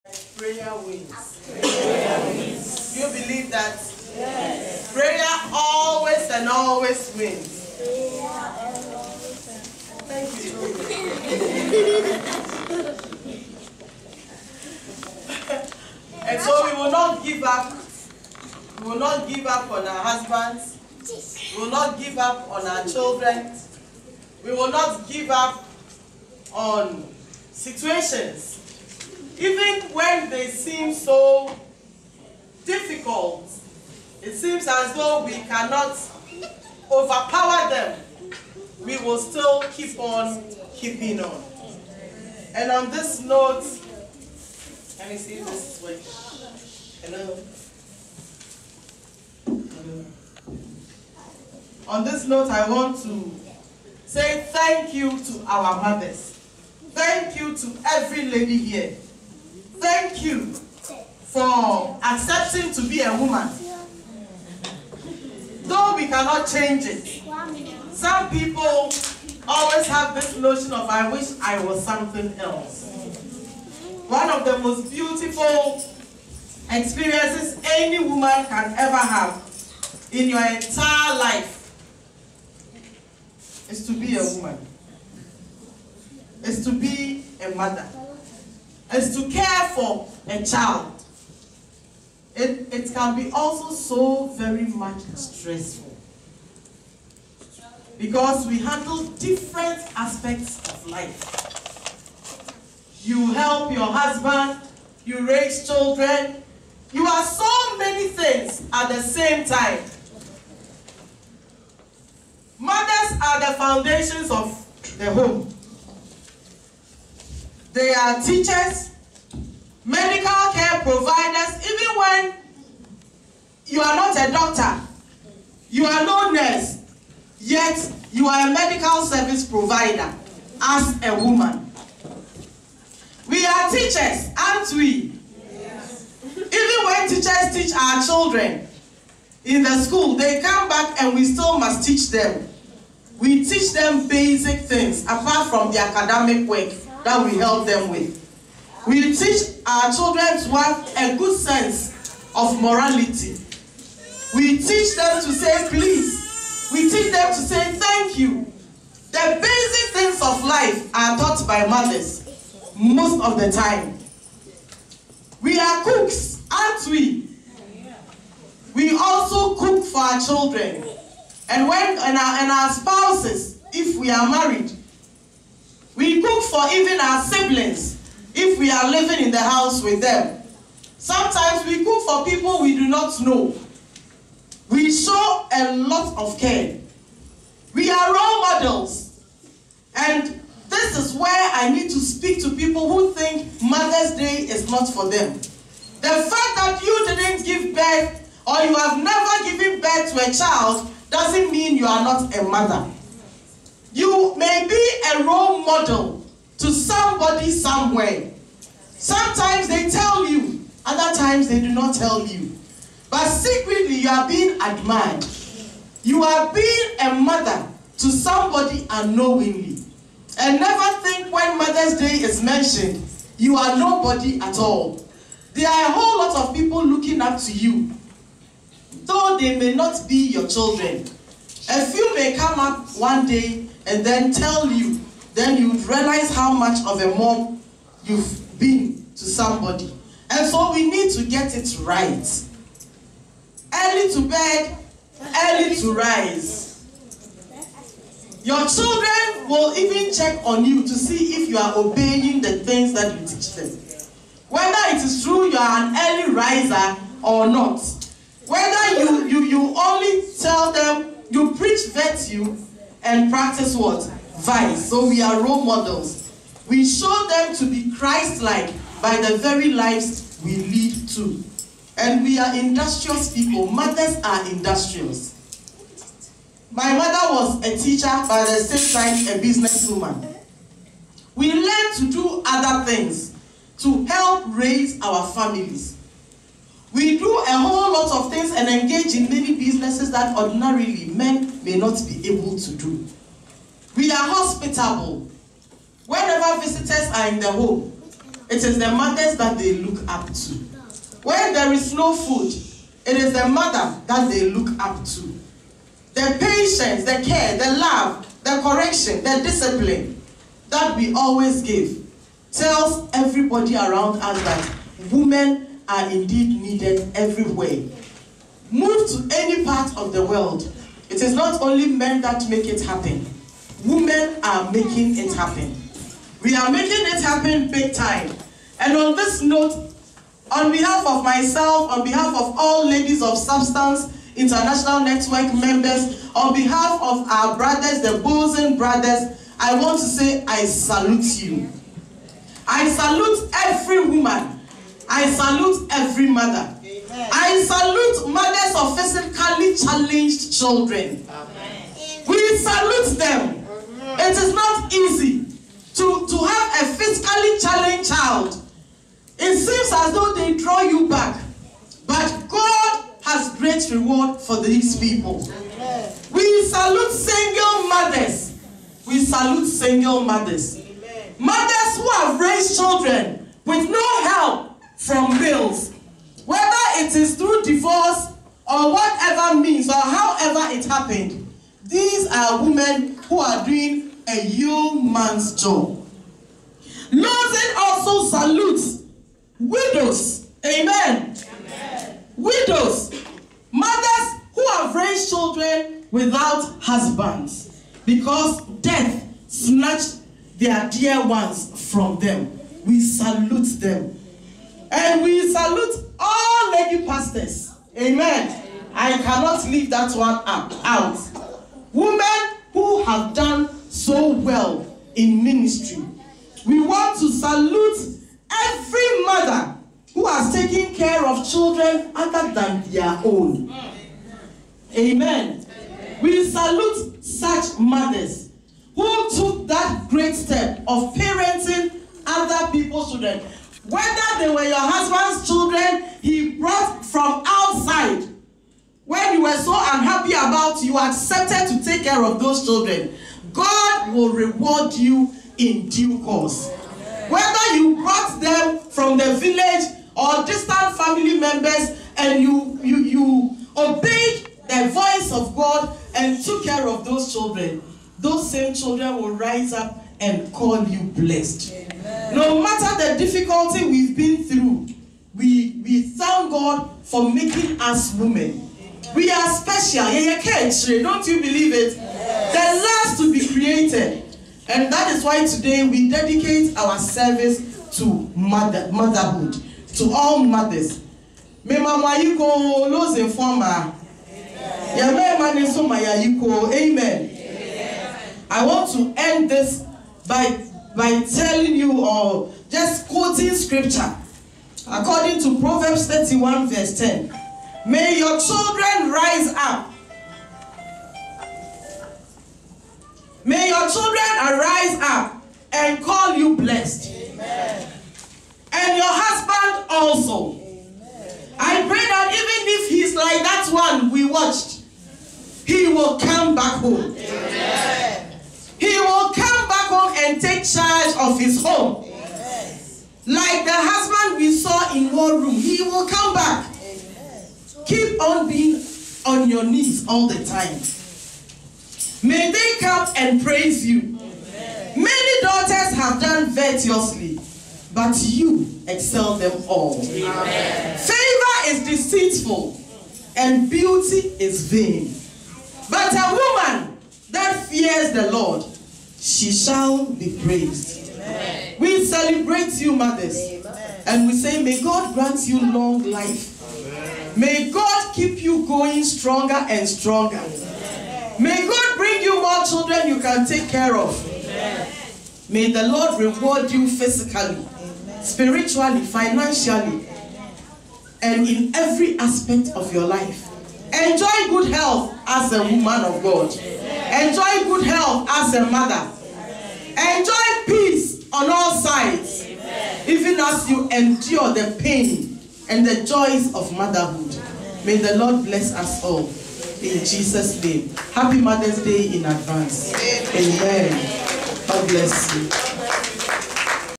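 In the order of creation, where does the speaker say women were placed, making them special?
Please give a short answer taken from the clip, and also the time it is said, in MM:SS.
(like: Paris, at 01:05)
The last, at 07:51.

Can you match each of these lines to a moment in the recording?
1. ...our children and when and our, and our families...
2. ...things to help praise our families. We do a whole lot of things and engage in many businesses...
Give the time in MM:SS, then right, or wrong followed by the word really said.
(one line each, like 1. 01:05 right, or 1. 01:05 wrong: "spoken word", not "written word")
1. 02:49 wrong: "spouses", not "families"
2. 04:42 wrong: "raise", not "praise".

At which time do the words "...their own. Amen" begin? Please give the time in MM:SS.
07:02.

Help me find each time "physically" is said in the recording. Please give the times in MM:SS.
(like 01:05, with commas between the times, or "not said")
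05:48, 05:56, 09:26.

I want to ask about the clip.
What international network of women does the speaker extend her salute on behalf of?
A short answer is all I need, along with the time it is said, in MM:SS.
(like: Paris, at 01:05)
Ladies of Substance, at 05:32.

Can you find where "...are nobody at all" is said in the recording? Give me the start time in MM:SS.
03:43.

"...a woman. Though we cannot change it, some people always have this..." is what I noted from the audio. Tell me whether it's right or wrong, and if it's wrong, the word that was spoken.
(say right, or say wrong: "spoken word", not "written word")
right.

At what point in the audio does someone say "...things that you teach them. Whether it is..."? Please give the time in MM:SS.
04:12.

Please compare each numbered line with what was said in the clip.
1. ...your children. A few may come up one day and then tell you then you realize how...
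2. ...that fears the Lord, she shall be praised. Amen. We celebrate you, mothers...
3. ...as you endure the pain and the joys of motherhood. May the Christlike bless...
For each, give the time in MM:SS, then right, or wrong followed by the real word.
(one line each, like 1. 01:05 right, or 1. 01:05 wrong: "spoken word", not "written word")
1. 03:50 right
2. 09:07 right
3. 09:43 wrong: "Lord", not "Christlike".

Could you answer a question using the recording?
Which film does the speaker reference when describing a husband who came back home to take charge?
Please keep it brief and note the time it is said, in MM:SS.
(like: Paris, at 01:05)
War Room, at 08:45.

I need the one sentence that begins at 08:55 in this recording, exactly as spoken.
Many daughters have done virtuously, but you excel them all.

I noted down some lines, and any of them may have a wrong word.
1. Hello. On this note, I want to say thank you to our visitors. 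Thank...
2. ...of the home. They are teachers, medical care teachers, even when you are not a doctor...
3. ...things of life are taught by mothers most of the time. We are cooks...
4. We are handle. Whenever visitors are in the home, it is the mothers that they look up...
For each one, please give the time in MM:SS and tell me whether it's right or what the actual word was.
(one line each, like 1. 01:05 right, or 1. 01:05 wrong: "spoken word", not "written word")
1. 00:49 wrong: "mothers", not "visitors"
2. 01:54 wrong: "providers", not "teachers"
3. 02:39 right
4. 04:53 wrong: "hospitable", not "handle".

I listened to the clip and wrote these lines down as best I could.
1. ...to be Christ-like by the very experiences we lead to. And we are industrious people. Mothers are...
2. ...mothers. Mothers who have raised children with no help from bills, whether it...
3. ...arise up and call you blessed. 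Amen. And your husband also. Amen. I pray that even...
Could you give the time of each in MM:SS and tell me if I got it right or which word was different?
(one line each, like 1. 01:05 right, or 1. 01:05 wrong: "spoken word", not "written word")
1. 04:27 wrong: "lives", not "experiences"
2. 06:10 right
3. 08:24 right.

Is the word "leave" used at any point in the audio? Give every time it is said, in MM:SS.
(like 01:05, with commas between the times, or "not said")
06:49.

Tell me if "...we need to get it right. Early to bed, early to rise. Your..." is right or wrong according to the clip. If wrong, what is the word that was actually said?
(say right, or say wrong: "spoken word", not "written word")
right.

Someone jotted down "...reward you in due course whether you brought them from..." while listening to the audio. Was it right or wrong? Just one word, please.
right.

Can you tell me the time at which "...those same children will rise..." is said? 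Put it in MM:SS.
07:38.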